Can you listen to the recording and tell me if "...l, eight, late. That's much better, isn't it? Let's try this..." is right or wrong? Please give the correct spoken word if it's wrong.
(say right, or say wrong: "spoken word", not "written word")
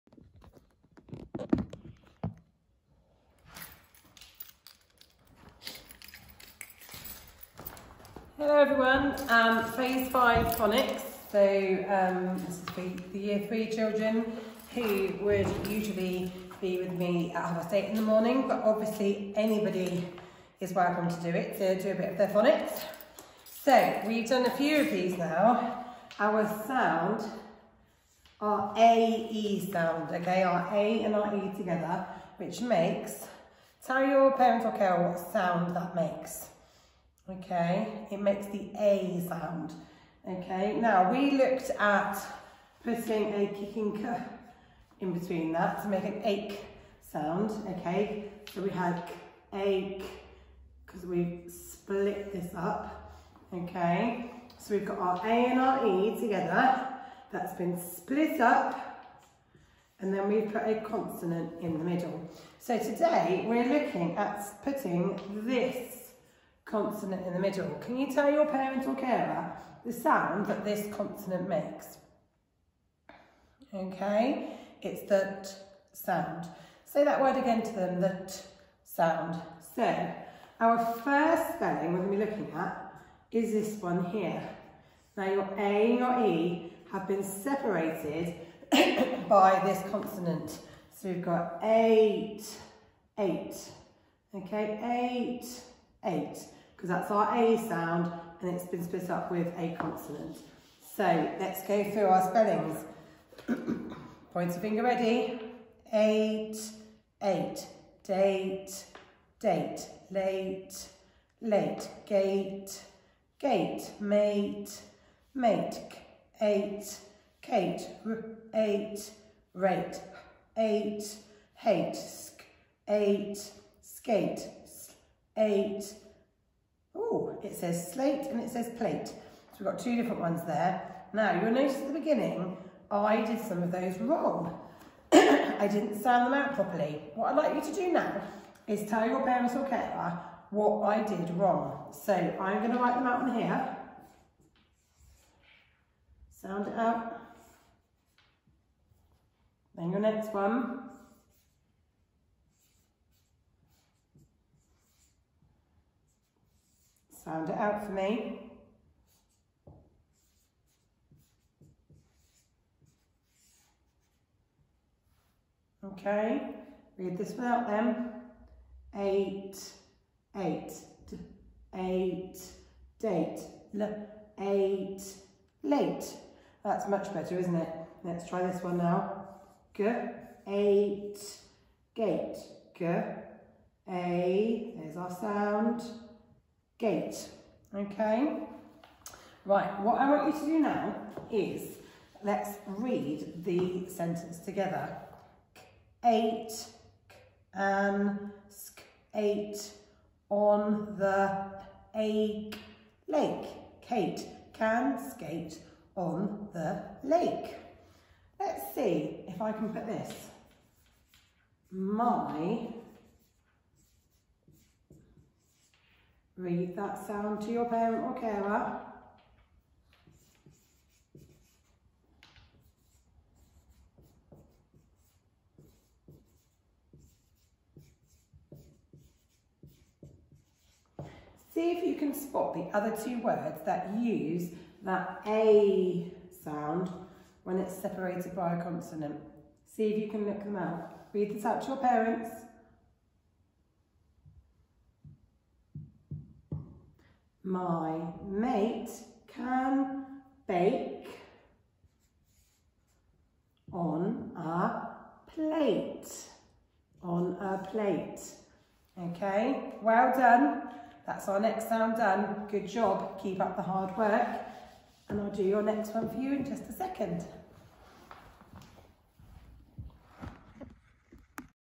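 right.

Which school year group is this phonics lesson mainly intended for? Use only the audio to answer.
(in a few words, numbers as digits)
Year 3.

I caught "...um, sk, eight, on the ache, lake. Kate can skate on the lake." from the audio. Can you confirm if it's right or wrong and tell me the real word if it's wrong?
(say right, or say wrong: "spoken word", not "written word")
right.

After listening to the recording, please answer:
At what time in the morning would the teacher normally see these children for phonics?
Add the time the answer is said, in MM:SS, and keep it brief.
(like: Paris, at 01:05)
half past eight, at 00:17.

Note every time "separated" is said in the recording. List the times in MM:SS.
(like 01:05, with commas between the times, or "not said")
01:27, 03:57.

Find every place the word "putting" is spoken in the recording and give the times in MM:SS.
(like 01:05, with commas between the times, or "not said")
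00:42, 01:04.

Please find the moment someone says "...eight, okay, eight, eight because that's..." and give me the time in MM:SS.
01:33.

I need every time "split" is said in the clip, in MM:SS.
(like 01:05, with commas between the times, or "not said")
00:51, 00:57, 01:38.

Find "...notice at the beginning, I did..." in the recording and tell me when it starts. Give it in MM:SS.
02:11.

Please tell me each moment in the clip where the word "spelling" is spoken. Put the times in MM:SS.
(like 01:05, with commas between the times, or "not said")
01:21, 01:42.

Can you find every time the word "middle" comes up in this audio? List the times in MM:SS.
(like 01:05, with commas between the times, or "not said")
01:01, 01:07.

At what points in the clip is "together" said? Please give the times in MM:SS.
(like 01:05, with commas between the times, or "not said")
00:31, 00:56, 03:14.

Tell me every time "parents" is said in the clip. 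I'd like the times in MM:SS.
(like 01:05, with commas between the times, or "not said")
00:34, 01:08, 02:19, 03:37, 04:01.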